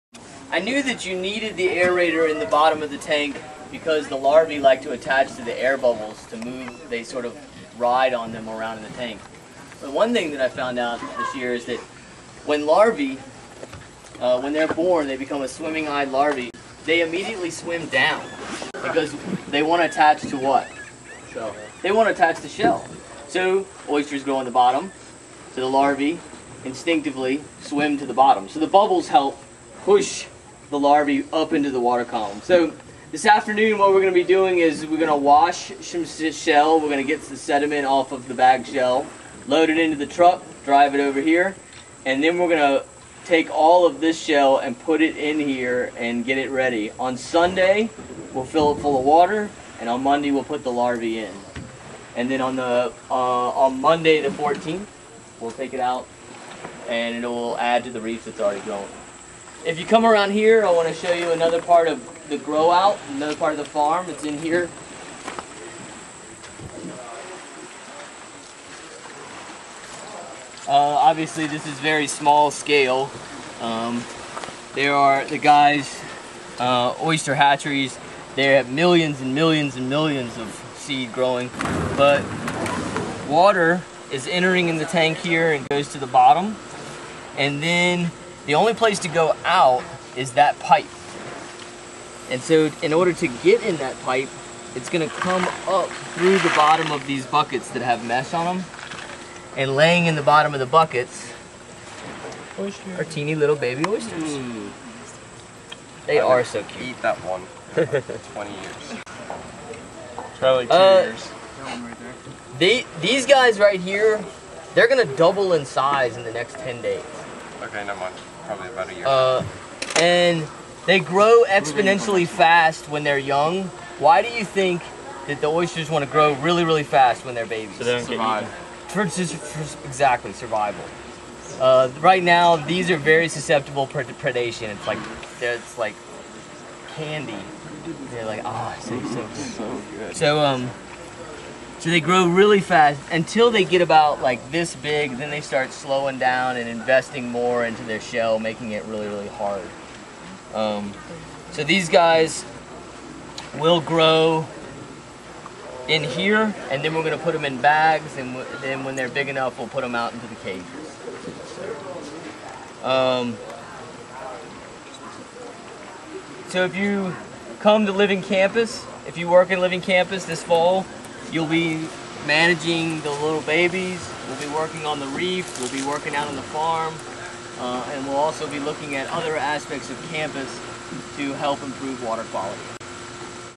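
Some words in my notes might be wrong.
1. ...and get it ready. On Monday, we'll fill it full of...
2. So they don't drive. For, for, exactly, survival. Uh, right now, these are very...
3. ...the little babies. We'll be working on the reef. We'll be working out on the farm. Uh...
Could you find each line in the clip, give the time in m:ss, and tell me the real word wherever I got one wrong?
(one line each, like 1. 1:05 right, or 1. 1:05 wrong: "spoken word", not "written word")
1. 0:45 wrong: "Sunday", not "Monday"
2. 2:07 wrong: "survive", not "drive"
3. 2:53 right.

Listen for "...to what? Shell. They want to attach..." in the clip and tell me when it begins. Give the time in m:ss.
0:20.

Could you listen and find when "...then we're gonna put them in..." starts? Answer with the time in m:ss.
2:36.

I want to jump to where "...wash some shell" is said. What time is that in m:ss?
0:35.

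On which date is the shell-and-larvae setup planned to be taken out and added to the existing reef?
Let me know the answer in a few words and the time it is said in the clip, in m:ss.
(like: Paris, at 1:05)
Monday the 14th, at 0:53.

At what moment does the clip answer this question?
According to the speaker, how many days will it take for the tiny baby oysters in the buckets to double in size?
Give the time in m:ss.
1:56.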